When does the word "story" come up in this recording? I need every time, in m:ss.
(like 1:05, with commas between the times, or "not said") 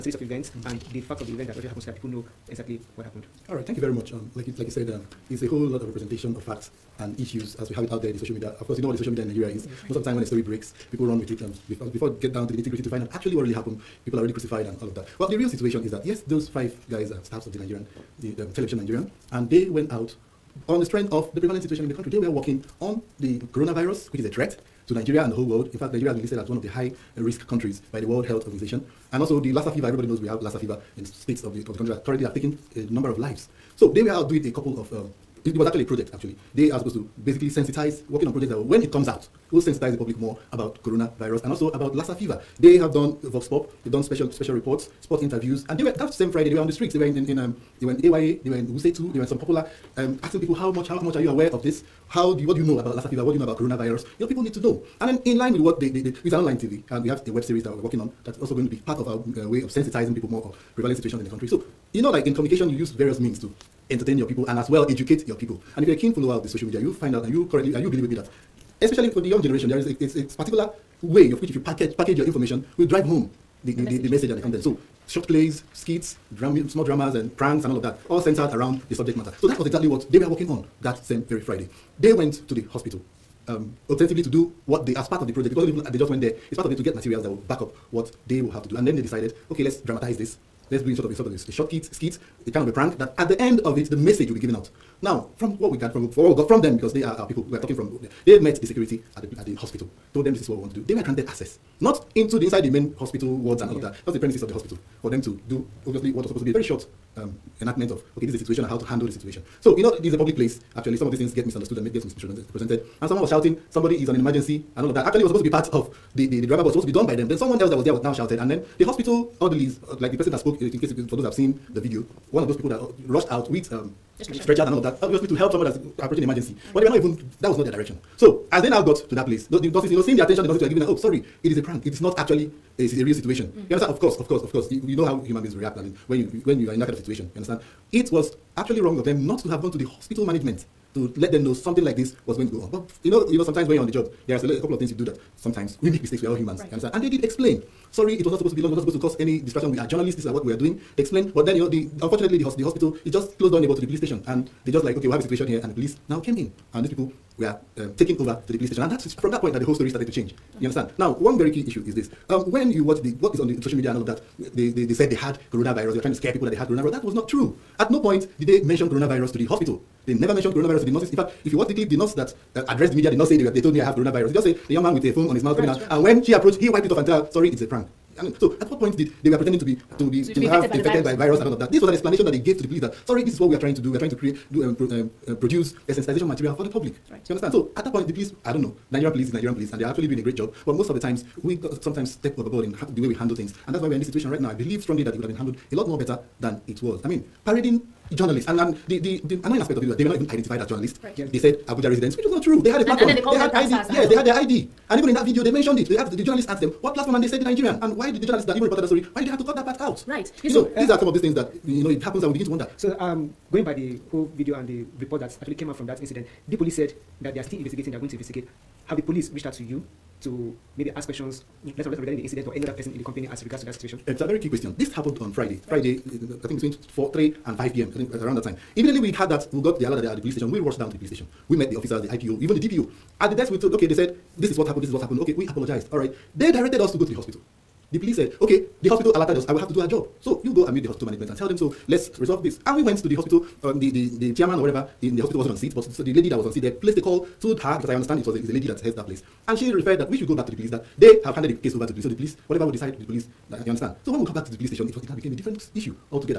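0:10, 2:39, 3:28.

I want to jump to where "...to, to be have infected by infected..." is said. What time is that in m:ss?
3:00.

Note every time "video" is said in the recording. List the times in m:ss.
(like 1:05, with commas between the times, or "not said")
2:01, 3:25, 3:34.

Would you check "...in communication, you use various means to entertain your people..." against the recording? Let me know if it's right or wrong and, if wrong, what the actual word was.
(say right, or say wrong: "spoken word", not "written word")
right.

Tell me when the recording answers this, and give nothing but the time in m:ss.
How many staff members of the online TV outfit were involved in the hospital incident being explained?
0:16.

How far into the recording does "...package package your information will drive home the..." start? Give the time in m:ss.
1:11.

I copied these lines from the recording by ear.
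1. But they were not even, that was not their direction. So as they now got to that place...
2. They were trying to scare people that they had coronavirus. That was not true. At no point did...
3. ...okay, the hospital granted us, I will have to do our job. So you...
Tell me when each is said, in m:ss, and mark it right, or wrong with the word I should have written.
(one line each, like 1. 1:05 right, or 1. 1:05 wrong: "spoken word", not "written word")
1. 2:06 right
2. 2:45 right
3. 3:58 wrong: "alerted", not "granted".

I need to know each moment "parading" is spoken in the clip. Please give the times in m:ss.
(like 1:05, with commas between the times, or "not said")
3:17.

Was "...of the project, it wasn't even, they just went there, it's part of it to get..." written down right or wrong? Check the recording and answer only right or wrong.
right.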